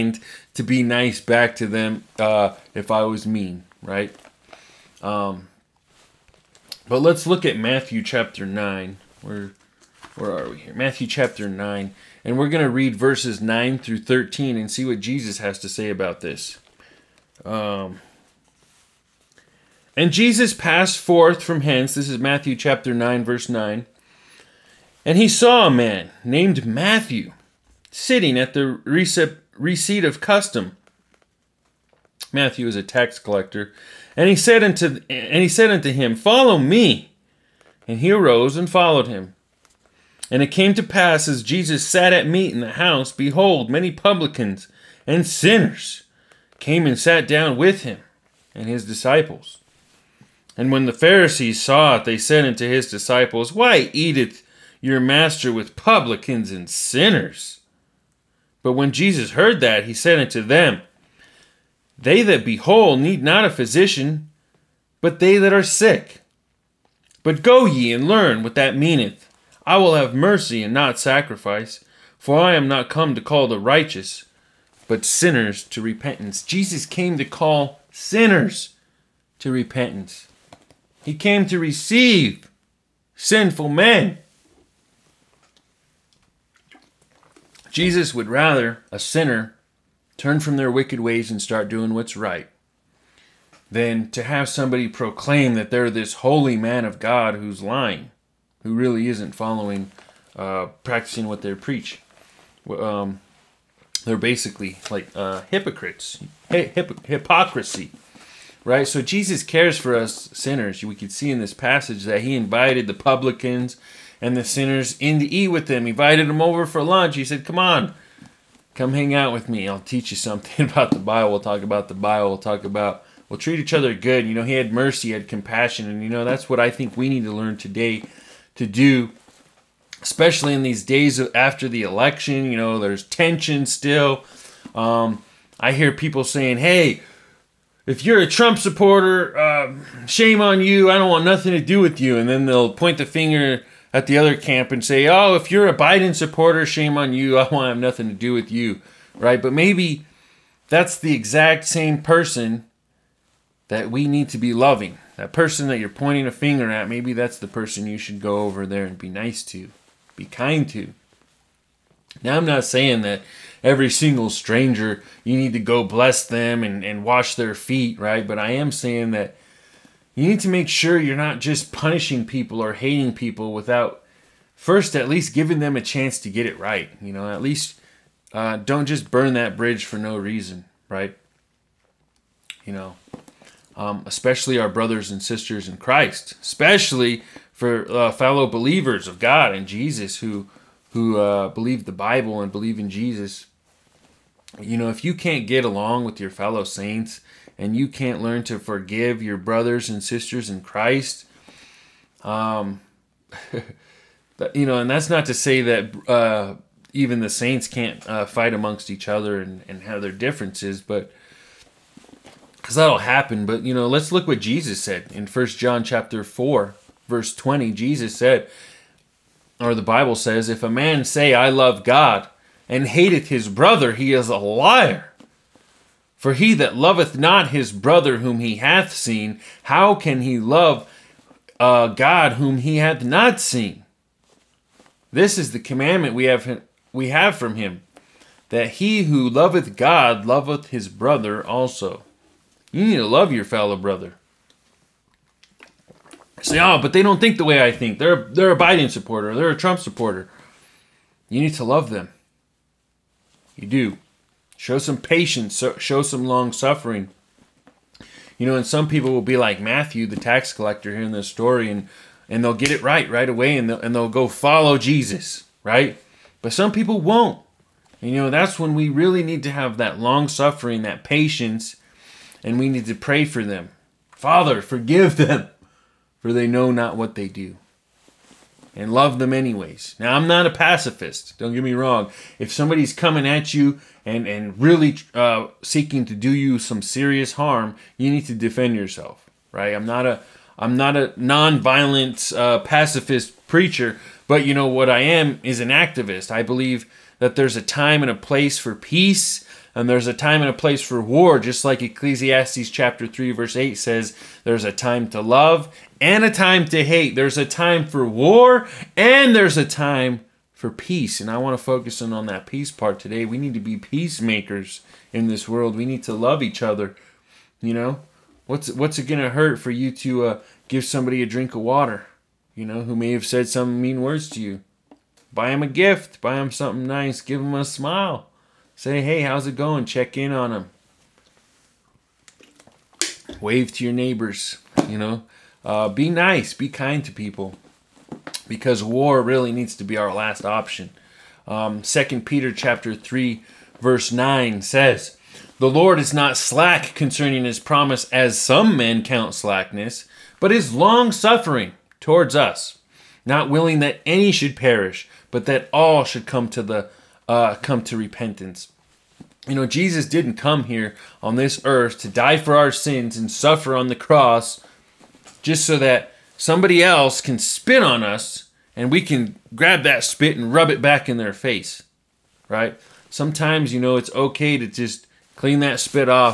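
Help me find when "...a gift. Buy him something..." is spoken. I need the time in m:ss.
5:25.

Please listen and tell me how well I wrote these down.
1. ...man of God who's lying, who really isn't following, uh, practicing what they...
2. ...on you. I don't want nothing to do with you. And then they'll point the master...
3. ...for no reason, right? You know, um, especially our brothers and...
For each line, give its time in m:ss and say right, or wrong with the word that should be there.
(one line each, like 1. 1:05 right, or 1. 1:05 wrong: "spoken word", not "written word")
1. 1:36 right
2. 2:20 wrong: "finger", not "master"
3. 2:59 right.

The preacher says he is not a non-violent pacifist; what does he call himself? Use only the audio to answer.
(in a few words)
An activist.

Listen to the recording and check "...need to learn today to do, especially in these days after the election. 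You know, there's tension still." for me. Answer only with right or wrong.
right.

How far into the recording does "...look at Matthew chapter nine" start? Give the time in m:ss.
0:07.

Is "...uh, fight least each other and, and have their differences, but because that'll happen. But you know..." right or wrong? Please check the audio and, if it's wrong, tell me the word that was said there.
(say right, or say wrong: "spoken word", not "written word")
wrong: "amongst", not "least".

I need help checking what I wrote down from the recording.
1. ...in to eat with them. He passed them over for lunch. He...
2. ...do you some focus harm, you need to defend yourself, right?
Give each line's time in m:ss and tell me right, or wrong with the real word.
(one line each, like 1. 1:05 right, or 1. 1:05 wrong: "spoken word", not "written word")
1. 1:54 wrong: "invited", not "passed"
2. 4:46 wrong: "serious", not "focus".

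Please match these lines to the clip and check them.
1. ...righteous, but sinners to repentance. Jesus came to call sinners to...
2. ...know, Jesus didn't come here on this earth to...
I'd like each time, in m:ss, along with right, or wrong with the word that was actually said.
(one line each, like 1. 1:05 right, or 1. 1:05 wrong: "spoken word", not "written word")
1. 1:13 right
2. 5:59 right.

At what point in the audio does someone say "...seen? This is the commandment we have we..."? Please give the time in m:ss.
3:53.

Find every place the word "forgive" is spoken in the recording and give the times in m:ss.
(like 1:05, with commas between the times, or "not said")
3:18, 4:34.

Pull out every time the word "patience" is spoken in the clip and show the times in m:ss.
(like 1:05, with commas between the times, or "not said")
4:14, 4:31.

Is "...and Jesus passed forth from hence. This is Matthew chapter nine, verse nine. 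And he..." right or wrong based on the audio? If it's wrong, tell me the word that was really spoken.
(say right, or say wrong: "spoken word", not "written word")
right.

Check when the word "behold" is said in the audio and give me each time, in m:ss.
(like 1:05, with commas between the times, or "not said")
0:43.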